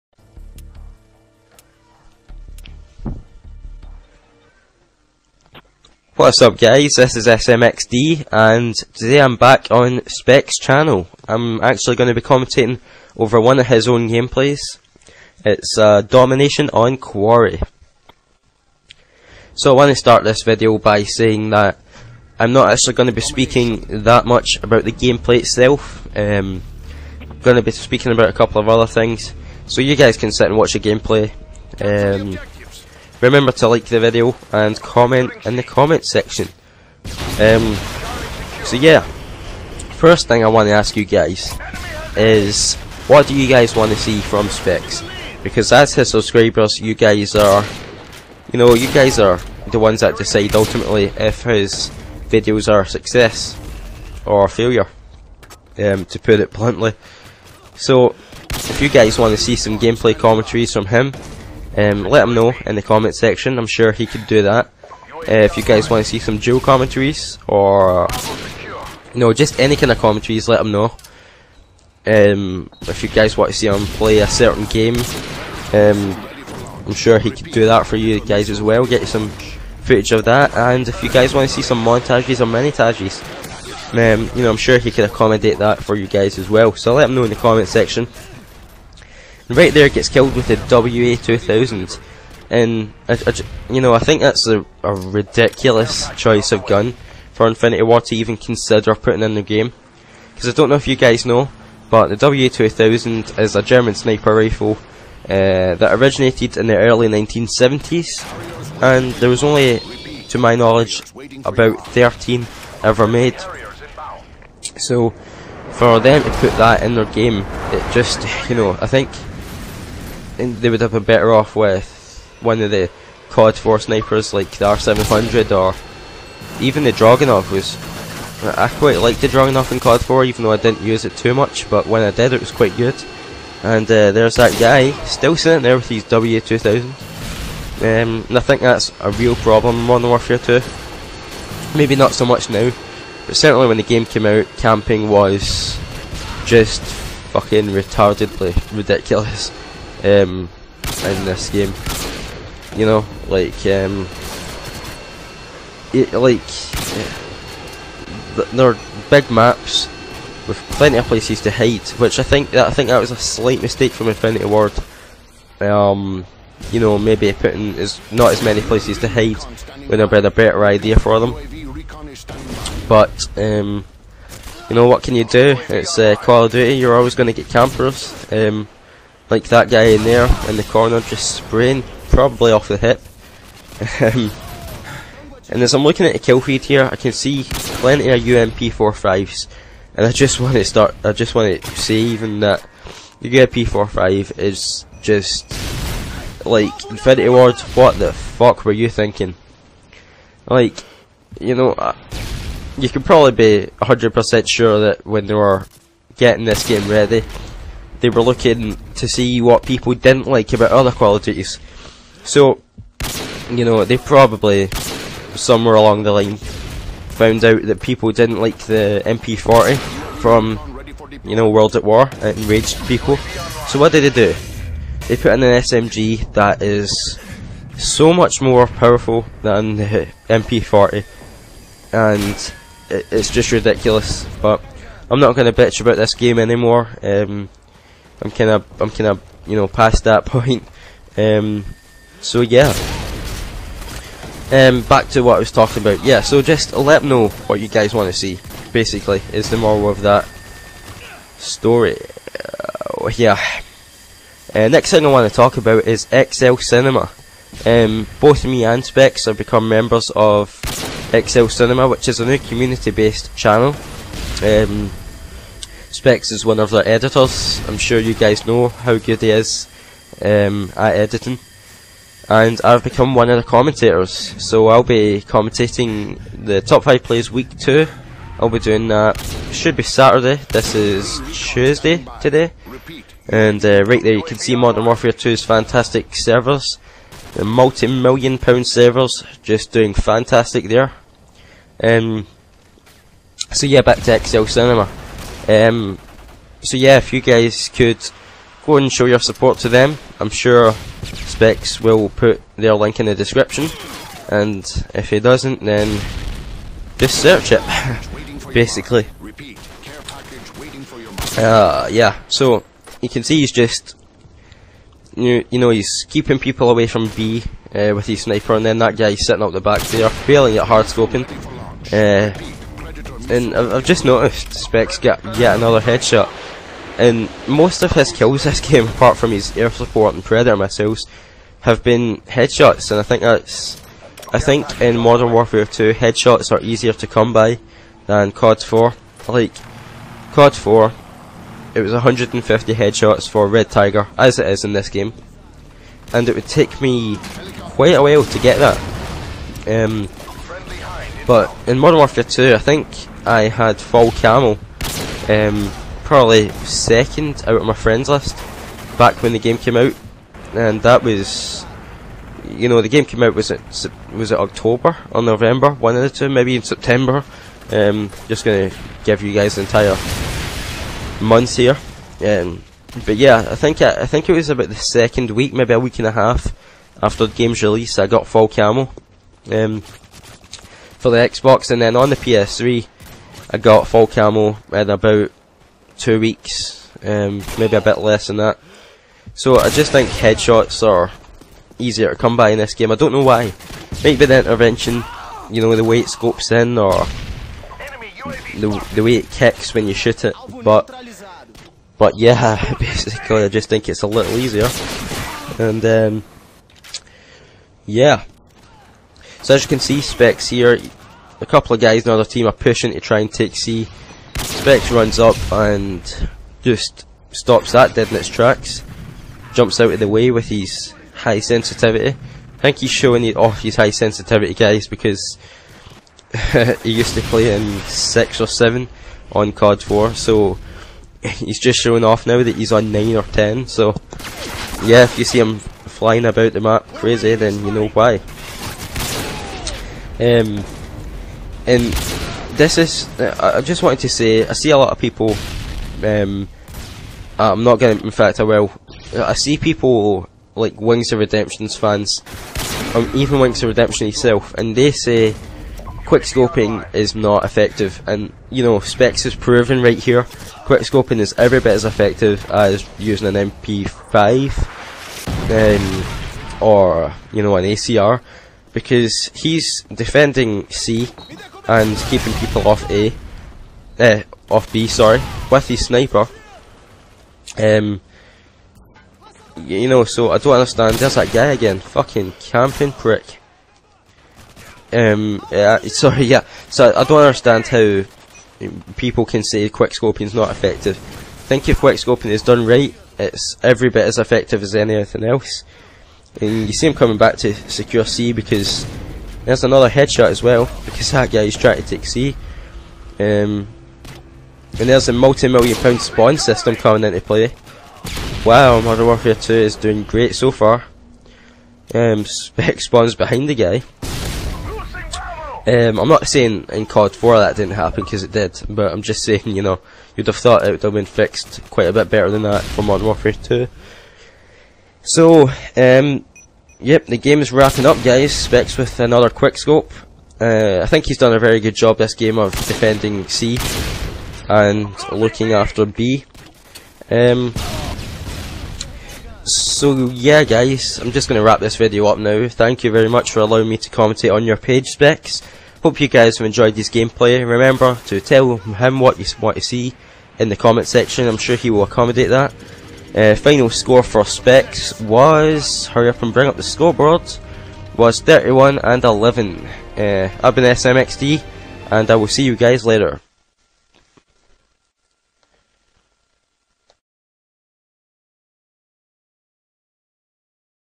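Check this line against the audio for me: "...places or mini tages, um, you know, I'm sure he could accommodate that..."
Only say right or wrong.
wrong.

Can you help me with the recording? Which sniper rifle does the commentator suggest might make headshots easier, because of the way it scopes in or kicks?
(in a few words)
intervention.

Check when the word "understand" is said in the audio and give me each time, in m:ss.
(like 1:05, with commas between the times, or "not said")
8:00, 8:07.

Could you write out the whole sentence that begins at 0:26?
Um, I'm going to be speaking about a couple of other things.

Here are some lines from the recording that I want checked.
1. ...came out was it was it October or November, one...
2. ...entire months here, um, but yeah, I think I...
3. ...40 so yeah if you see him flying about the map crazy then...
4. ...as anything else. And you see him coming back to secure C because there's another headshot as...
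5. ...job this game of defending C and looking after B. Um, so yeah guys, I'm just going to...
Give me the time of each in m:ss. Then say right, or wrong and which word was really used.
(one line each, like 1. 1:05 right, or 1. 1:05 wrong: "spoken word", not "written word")
1. 6:03 right
2. 6:09 right
3. 7:13 wrong: "10", not "40"
4. 8:14 right
5. 8:51 right.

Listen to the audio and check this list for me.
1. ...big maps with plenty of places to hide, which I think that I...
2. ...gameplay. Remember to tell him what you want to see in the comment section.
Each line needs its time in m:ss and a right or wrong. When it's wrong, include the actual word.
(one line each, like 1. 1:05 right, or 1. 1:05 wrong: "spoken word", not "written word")
1. 2:39 right
2. 9:06 right.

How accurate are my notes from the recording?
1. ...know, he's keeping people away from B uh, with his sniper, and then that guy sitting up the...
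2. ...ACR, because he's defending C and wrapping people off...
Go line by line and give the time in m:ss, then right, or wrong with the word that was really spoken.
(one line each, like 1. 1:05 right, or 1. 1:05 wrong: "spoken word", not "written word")
1. 5:15 right
2. 7:47 wrong: "keeping", not "wrapping".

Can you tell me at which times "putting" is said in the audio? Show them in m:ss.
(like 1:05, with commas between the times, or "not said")
1:38, 2:47.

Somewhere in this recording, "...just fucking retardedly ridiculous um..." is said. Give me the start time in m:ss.
2:26.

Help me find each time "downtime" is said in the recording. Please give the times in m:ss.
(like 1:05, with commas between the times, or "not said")
not said.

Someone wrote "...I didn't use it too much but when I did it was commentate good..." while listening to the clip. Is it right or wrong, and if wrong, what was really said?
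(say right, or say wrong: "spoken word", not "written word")
wrong: "quite", not "commentate".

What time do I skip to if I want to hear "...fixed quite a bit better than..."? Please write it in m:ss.
8:41.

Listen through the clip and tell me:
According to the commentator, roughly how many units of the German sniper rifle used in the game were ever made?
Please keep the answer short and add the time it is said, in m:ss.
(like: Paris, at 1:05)
13, at 1:51.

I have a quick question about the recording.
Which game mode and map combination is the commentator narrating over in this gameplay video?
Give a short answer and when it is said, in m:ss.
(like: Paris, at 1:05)
Domination on Quarry, at 0:16.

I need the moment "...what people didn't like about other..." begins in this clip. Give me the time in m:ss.
3:29.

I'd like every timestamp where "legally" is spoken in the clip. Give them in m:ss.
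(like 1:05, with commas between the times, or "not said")
not said.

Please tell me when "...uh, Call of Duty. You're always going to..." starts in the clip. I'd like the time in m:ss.
2:55.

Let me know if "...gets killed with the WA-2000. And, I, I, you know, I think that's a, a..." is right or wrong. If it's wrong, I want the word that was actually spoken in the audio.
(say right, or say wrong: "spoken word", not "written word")
right.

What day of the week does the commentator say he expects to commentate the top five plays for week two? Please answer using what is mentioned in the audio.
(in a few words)
Saturday.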